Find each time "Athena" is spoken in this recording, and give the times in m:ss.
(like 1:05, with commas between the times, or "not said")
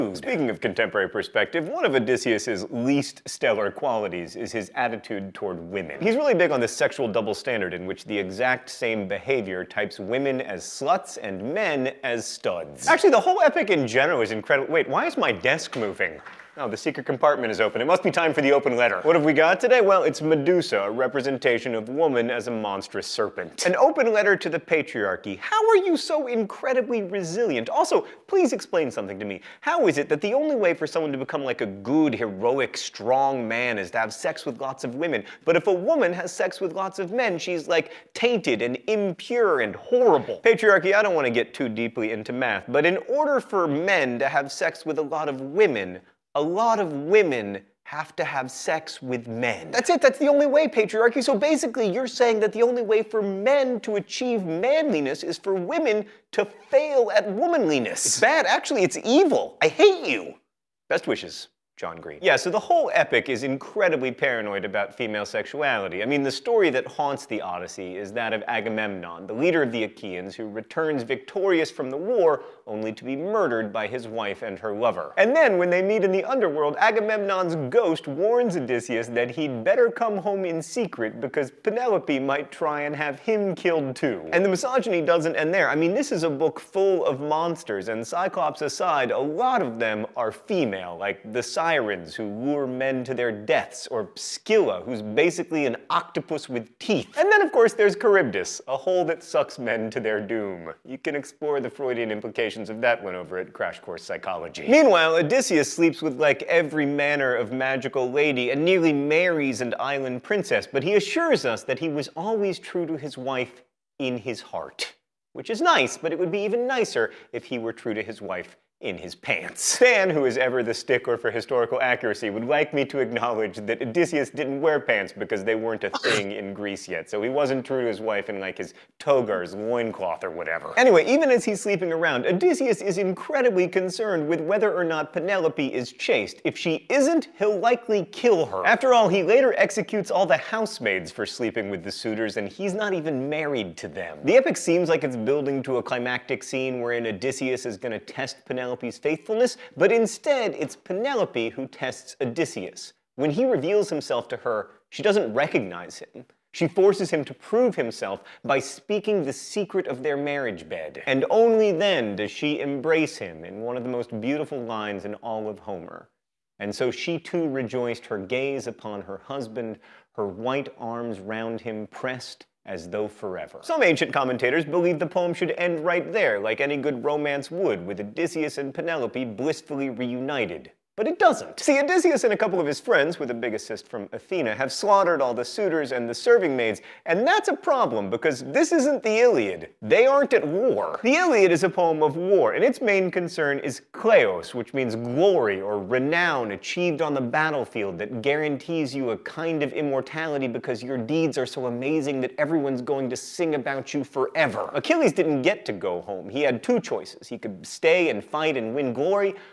3:04.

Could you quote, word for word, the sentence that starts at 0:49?
That's it, that's the only way, patriarchy.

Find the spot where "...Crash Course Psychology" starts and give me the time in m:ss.
1:43.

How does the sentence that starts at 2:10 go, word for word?
Anyway, even as he's sleeping around, Odysseus is incredibly concerned with whether or not Penelope is chaste.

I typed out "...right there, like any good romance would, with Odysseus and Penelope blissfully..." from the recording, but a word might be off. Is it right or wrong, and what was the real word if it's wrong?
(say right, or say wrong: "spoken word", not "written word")
right.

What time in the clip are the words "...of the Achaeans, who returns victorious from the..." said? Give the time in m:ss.
1:09.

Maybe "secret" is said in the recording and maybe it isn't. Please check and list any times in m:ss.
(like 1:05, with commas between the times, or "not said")
0:16, 1:20, 2:39.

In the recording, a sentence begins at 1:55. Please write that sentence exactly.
Which is nice, but it would be even nicer if he were true to his wife in his pants.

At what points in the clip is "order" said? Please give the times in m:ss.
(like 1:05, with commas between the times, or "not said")
0:43.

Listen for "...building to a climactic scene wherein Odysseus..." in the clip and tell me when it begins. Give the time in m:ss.
2:25.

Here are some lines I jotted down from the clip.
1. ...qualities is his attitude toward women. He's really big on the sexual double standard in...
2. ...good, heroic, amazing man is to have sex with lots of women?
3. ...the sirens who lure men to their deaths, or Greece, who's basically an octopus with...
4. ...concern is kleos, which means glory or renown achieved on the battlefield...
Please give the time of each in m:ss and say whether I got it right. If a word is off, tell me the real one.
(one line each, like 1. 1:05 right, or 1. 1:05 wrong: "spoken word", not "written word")
1. 0:03 right
2. 0:31 wrong: "strong", not "amazing"
3. 1:31 wrong: "Scylla", not "Greece"
4. 3:13 right.